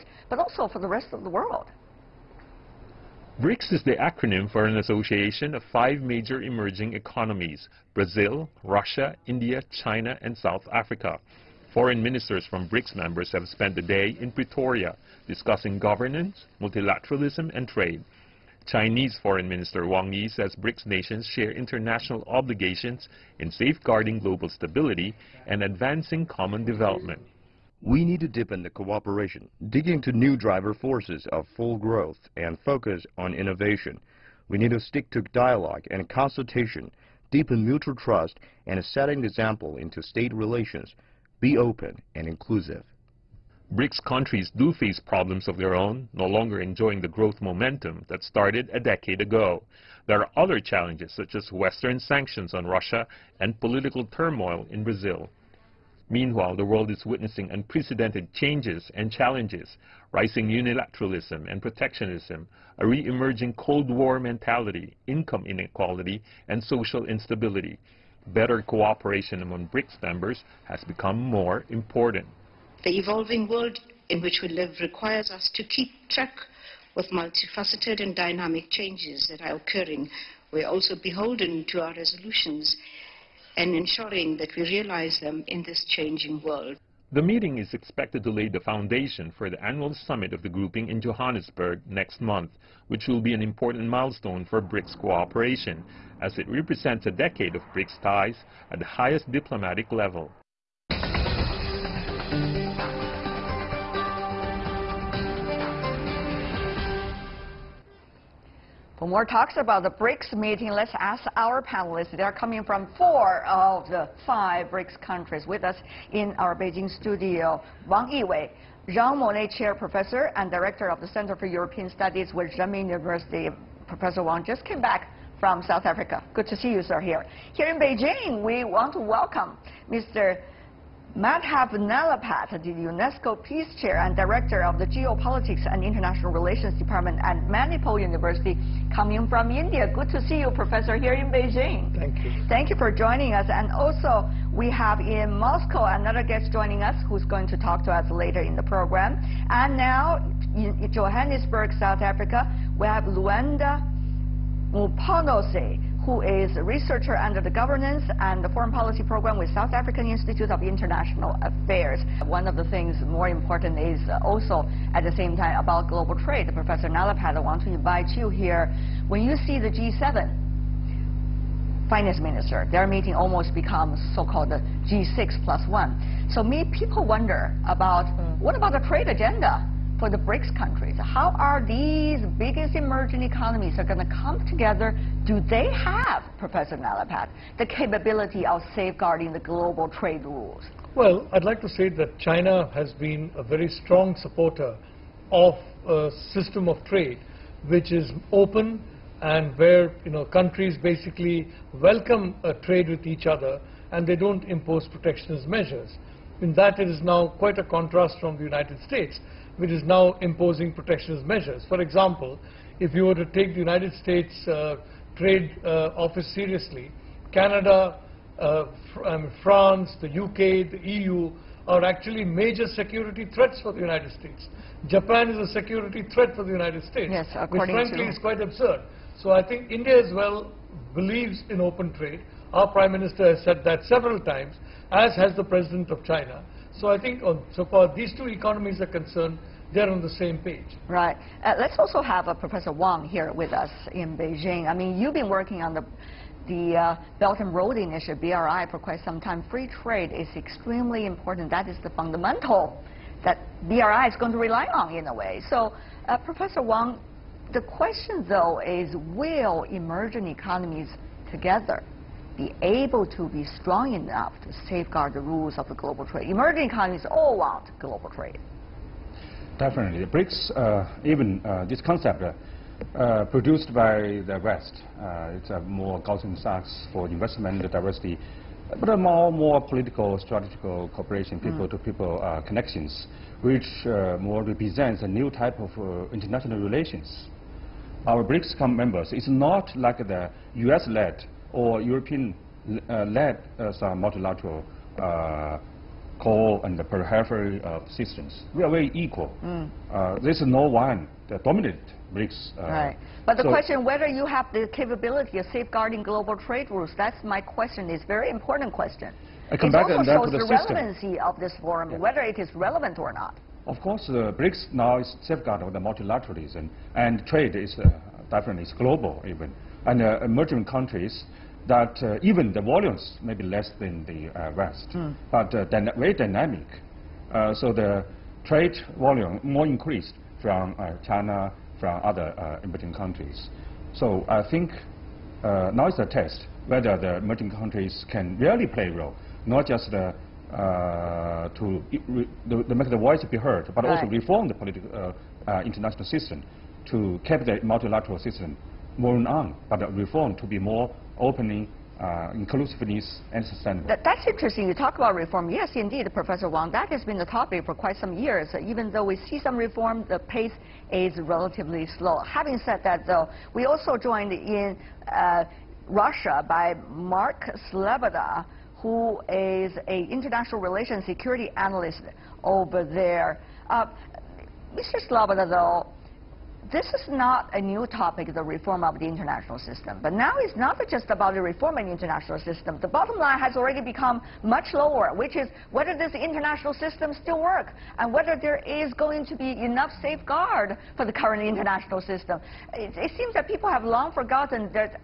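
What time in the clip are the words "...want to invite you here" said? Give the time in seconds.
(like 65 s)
167 s.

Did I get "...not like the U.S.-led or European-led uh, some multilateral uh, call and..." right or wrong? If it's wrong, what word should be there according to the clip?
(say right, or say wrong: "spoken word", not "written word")
right.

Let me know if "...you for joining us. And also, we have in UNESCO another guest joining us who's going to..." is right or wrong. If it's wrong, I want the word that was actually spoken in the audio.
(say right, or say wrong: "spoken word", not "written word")
wrong: "Moscow", not "UNESCO".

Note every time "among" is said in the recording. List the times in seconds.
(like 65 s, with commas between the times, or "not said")
69 s.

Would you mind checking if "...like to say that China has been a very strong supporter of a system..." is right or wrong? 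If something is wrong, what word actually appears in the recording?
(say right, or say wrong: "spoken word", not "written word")
right.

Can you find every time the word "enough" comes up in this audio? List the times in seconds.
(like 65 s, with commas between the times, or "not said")
263 s, 389 s.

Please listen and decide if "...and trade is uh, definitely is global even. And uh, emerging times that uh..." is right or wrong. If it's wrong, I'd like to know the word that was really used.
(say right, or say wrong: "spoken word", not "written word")
wrong: "countries", not "times".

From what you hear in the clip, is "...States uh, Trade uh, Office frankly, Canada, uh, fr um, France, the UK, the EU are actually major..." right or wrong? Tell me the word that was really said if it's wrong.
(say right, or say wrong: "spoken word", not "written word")
wrong: "seriously", not "frankly".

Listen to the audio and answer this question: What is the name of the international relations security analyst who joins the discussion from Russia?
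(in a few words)
Mark Sloboda.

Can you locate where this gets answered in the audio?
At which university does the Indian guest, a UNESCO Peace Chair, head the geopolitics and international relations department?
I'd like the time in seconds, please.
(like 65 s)
137 s.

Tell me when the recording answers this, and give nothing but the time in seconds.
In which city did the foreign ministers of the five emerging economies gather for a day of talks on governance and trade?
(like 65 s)
14 s.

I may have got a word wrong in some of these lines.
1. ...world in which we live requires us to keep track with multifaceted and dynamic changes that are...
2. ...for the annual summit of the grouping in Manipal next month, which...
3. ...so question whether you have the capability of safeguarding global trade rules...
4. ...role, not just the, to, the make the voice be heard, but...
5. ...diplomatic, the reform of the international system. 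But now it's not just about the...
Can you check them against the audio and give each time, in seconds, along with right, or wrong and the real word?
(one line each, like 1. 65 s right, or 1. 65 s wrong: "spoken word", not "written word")
1. 73 s right
2. 89 s wrong: "Johannesburg", not "Manipal"
3. 303 s right
4. 338 s right
5. 377 s wrong: "topic", not "diplomatic".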